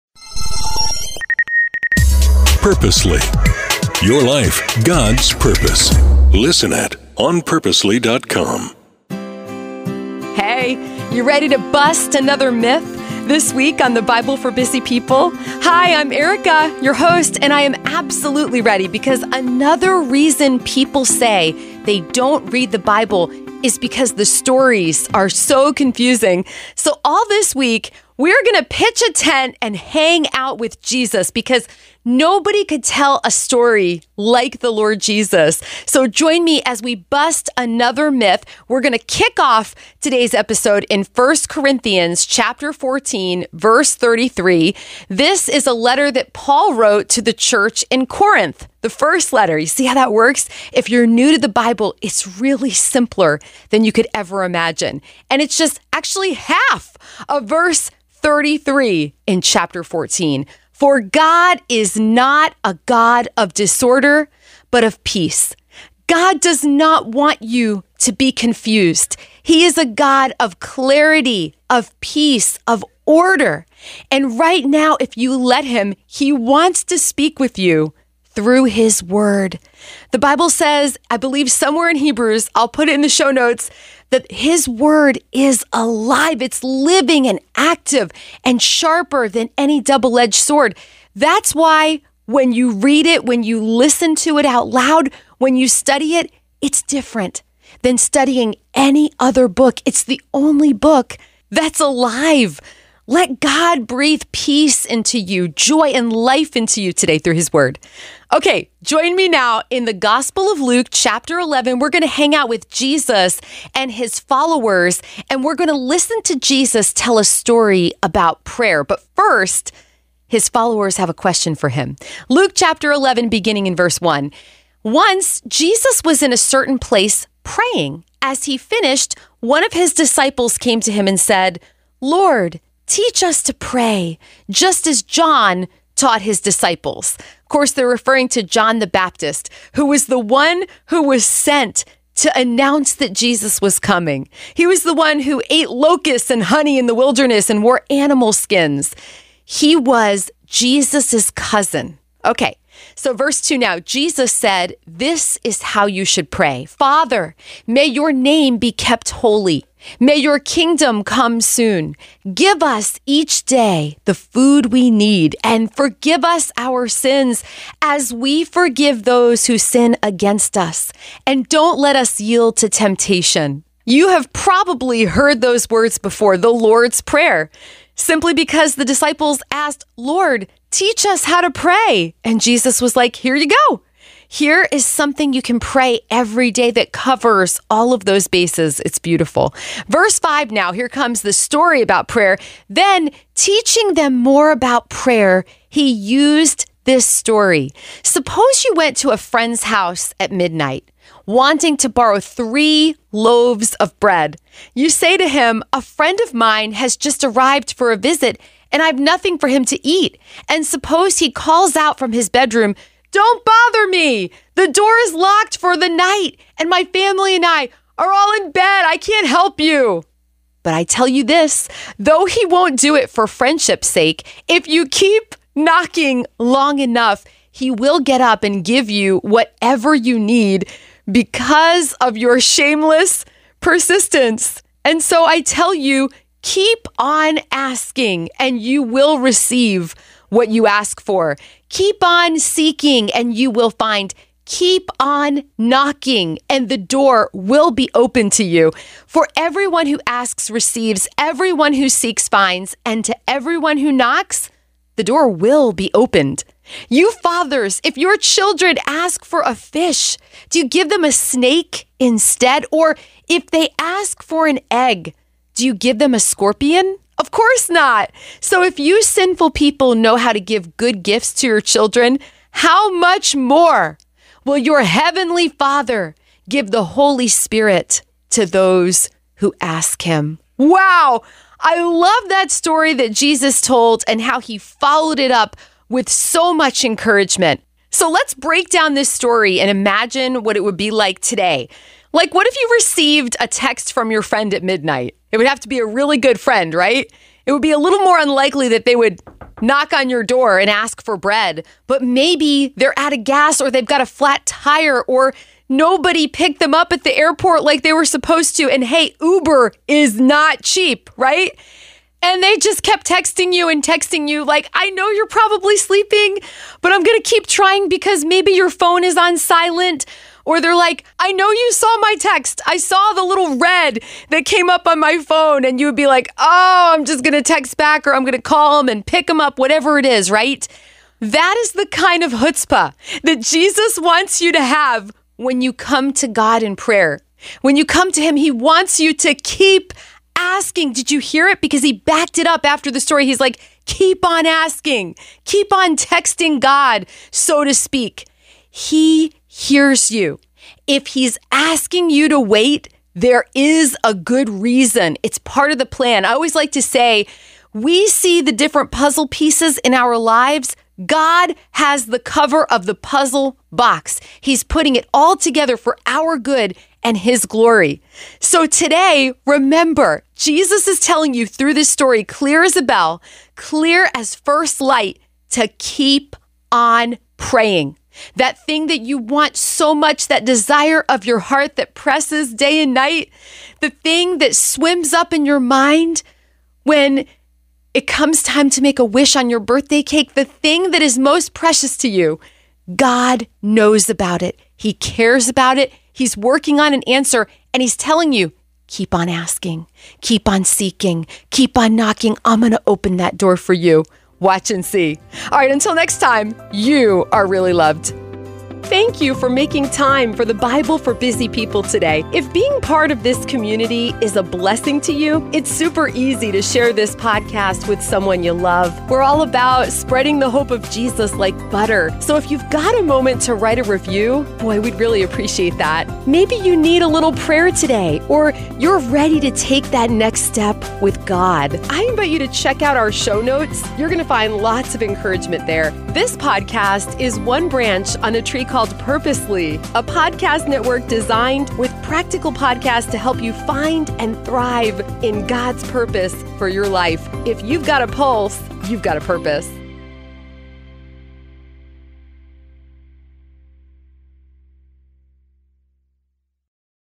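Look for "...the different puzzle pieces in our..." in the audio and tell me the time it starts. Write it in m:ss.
5:58.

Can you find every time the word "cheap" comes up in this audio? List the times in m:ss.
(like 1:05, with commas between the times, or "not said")
5:10.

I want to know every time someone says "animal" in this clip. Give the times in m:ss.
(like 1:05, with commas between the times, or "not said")
2:27.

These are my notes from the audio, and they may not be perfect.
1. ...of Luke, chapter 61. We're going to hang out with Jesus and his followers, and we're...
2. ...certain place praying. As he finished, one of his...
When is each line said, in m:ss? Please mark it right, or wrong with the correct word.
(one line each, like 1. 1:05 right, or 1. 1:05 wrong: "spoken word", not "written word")
1. 1:50 wrong: "11", not "61"
2. 2:06 right.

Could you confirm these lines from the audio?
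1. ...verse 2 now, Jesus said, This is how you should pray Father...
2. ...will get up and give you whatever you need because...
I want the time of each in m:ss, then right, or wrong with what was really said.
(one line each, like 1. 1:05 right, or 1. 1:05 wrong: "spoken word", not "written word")
1. 2:33 right
2. 3:47 right.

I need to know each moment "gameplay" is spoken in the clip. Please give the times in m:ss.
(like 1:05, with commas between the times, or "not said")
not said.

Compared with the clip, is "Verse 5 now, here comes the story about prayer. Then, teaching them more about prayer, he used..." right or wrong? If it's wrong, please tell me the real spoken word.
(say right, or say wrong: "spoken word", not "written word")
right.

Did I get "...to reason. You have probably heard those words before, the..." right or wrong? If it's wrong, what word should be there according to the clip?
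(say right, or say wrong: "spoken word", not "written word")
wrong: "temptation", not "reason".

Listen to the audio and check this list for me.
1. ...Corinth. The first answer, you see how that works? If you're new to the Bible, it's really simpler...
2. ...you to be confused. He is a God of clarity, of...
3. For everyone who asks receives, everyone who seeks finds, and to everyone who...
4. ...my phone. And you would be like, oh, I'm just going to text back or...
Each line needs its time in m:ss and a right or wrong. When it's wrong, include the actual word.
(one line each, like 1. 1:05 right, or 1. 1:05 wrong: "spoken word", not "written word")
1. 0:48 wrong: "letter", not "answer"
2. 1:07 right
3. 4:09 right
4. 5:24 right.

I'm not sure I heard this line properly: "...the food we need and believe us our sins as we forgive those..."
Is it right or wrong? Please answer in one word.
wrong.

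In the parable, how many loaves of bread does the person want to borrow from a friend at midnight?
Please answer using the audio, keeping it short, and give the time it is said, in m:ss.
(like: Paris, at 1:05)
3, at 3:22.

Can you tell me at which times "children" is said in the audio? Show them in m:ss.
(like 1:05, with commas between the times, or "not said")
4:18, 4:31.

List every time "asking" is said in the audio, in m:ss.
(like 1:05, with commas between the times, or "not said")
3:57, 5:40, 5:44, 5:51, 6:39.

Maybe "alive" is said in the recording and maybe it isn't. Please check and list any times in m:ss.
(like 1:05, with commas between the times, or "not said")
1:25, 1:41.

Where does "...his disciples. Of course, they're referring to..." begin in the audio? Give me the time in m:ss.
2:16.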